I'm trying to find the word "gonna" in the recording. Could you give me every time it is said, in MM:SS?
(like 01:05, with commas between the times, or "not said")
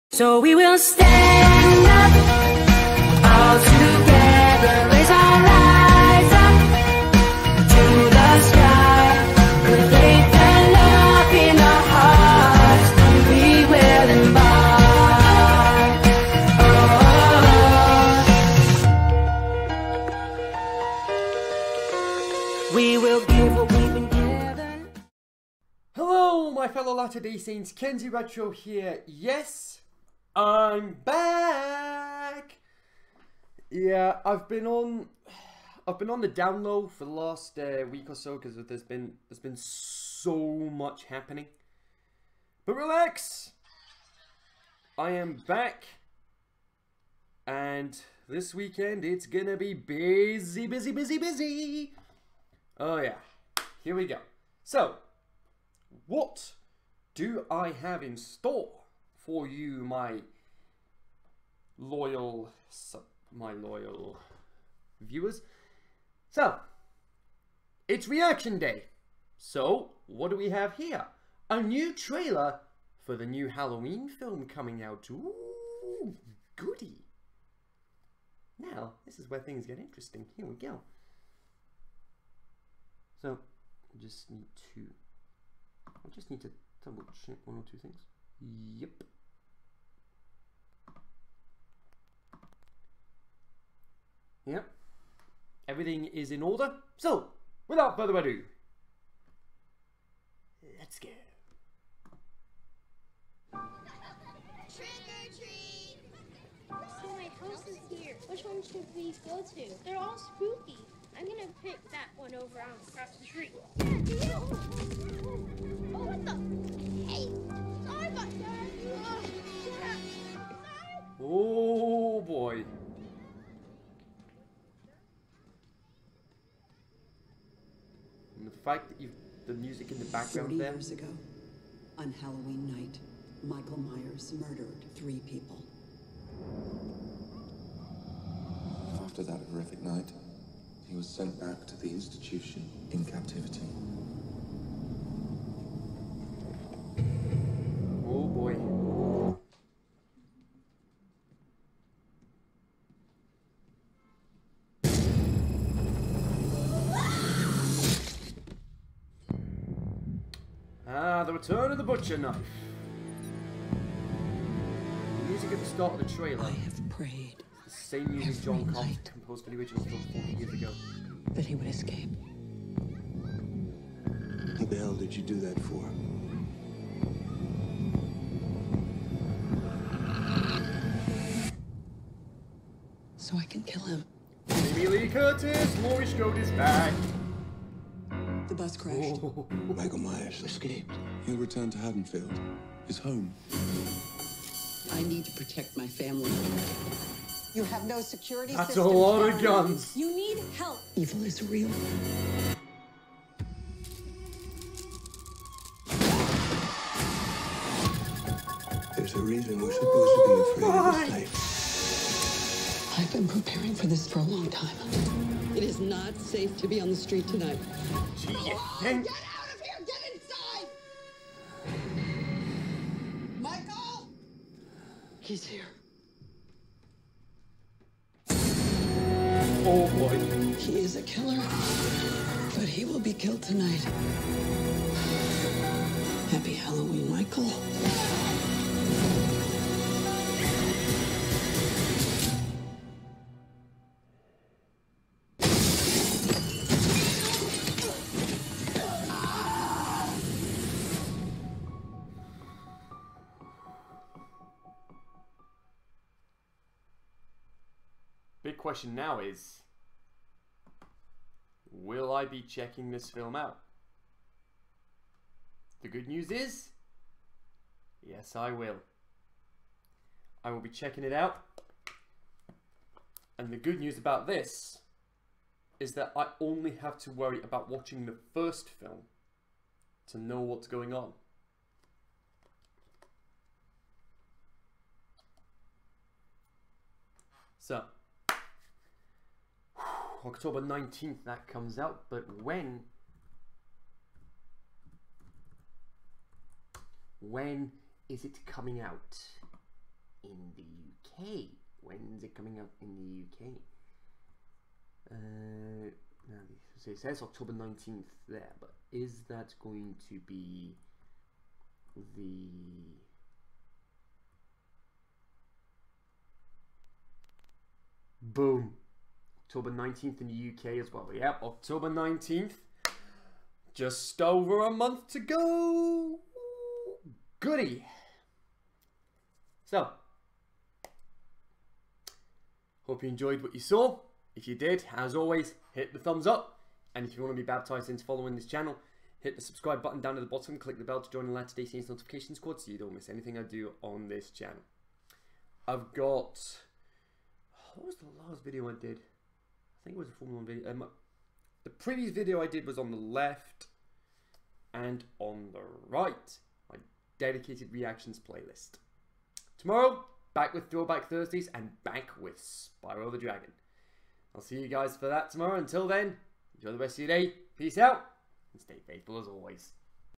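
00:49, 01:51.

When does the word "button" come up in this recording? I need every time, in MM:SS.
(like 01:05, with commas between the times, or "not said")
05:39.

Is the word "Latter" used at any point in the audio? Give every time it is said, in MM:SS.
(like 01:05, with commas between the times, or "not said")
00:26, 05:41.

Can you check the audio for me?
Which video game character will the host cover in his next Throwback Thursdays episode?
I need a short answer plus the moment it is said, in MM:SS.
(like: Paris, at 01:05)
Spyro the Dragon, at 06:02.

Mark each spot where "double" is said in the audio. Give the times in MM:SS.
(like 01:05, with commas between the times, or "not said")
01:26.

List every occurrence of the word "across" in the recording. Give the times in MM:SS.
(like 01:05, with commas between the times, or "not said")
01:52.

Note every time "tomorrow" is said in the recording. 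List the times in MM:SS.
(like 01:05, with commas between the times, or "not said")
05:59, 06:05.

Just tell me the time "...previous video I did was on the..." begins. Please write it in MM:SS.
05:51.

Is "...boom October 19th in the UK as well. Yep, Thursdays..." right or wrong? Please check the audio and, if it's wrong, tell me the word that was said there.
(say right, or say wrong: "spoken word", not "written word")
wrong: "October", not "Thursdays".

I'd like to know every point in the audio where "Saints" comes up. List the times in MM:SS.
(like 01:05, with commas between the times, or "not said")
00:27, 05:41.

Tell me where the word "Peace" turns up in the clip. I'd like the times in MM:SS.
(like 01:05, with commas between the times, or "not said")
06:07.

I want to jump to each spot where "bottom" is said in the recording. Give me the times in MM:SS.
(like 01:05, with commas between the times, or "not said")
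05:40.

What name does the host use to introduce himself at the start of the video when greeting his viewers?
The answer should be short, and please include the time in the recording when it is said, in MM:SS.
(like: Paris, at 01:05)
Kenzie Retro, at 00:27.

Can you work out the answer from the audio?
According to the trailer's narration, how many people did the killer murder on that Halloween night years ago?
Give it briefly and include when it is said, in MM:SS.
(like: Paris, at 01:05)
3, at 02:14.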